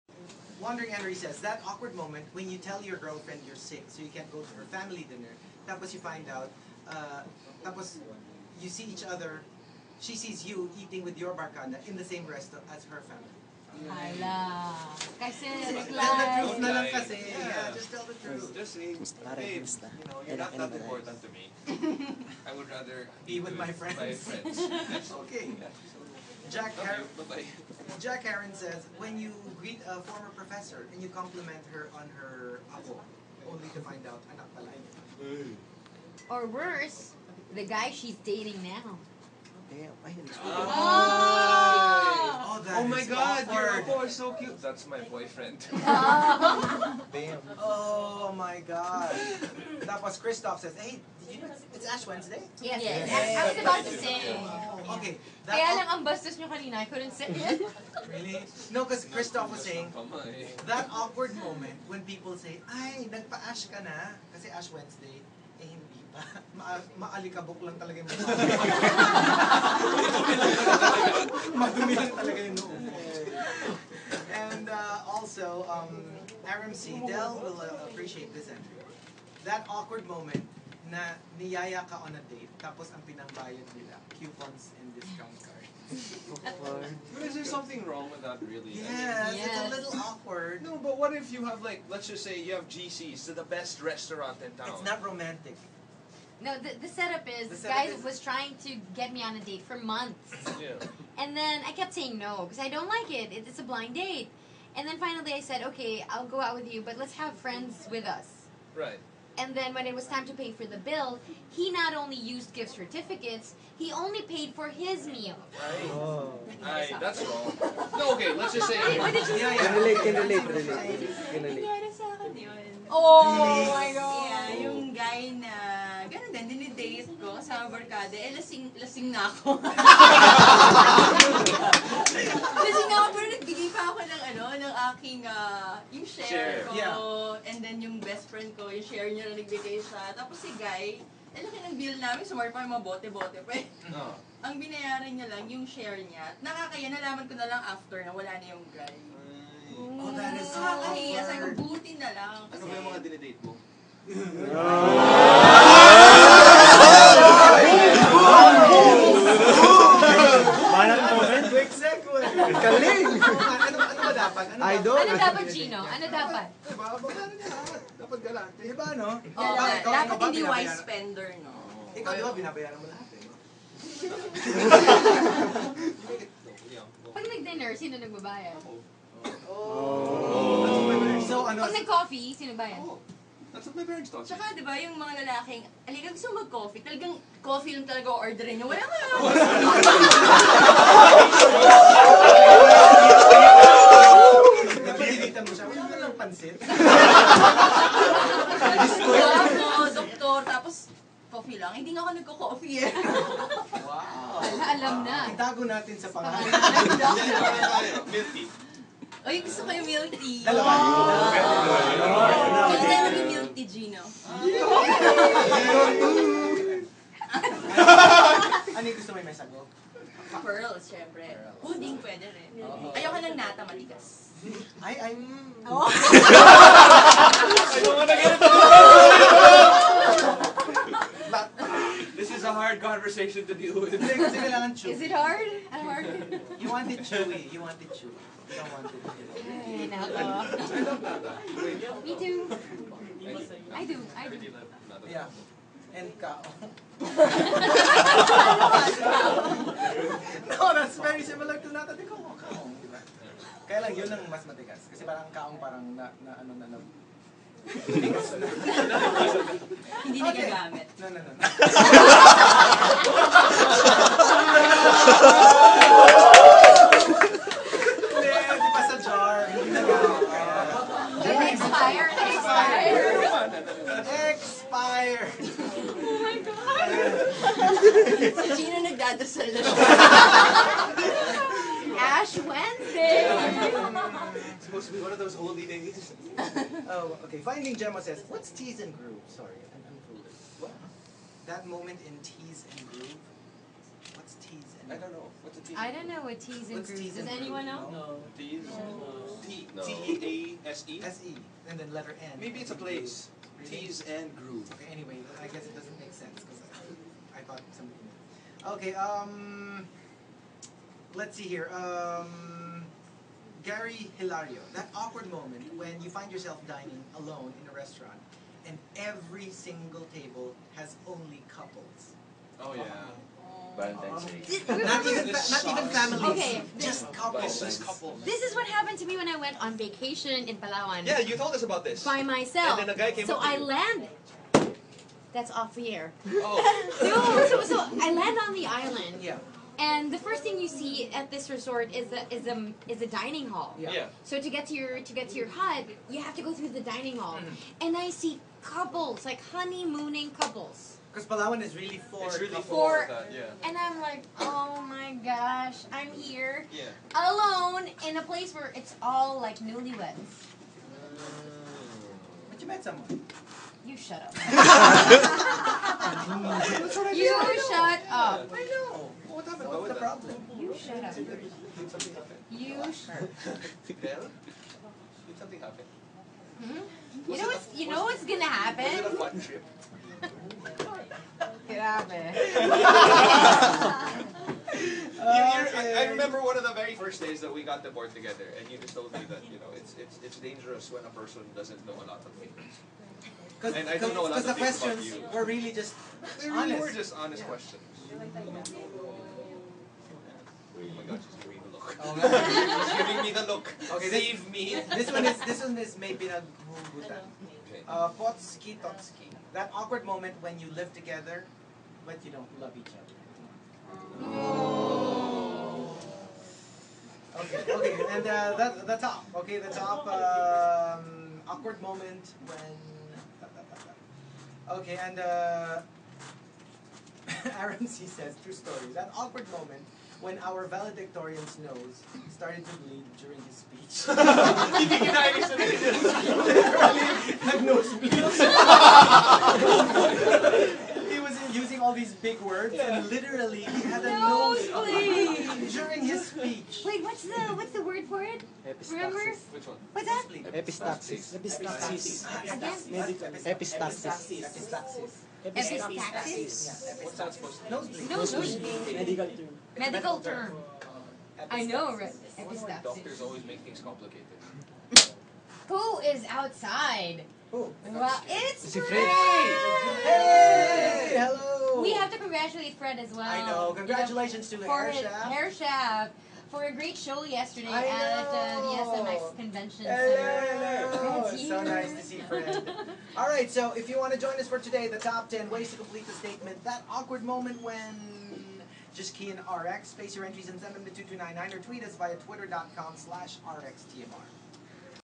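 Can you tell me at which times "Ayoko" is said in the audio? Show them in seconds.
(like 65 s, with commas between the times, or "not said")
222 s, 227 s.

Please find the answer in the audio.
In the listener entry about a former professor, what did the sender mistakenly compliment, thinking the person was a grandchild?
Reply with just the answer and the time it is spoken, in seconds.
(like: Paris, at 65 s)
her apo, at 32 s.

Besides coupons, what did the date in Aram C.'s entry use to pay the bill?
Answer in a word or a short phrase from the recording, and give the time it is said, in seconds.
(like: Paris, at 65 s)
discount cards, at 84 s.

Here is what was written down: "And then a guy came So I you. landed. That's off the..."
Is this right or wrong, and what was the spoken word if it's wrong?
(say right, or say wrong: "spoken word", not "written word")
right.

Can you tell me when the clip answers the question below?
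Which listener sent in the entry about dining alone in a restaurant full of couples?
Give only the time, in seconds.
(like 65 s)
313 s.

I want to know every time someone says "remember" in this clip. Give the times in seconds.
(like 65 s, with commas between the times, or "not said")
386 s, 448 s.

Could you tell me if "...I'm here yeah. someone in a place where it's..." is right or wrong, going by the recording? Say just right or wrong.
wrong.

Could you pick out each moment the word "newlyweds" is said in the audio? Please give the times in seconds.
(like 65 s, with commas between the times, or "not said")
359 s.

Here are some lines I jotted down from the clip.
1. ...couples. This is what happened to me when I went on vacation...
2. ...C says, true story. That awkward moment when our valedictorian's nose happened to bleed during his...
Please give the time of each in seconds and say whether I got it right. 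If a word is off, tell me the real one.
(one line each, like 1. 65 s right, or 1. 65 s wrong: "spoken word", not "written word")
1. 327 s right
2. 427 s wrong: "started", not "happened".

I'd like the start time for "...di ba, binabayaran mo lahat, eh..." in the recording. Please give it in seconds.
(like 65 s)
172 s.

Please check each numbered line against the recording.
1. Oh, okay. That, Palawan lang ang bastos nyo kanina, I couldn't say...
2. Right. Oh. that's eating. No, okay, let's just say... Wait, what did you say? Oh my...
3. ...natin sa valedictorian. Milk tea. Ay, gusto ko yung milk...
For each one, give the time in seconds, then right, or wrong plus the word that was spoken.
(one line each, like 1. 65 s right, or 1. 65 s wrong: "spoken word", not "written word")
1. 54 s wrong: "Kaya", not "Palawan"
2. 115 s wrong: "wrong", not "eating"
3. 205 s wrong: "pangalan", not "valedictorian".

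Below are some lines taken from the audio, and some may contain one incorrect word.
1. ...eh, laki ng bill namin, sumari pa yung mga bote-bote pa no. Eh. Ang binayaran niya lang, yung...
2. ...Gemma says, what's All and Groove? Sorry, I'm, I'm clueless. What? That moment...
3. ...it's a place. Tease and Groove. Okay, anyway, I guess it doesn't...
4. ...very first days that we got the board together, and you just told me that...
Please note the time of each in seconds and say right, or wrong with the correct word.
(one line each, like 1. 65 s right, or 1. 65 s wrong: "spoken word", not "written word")
1. 141 s right
2. 287 s wrong: "Tease", not "All"
3. 302 s right
4. 386 s right.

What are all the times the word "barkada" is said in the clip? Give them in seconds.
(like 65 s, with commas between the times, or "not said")
11 s, 127 s.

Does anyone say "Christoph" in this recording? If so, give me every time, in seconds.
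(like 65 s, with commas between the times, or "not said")
50 s, 59 s.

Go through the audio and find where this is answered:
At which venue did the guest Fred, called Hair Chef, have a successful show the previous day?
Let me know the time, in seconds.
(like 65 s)
479 s.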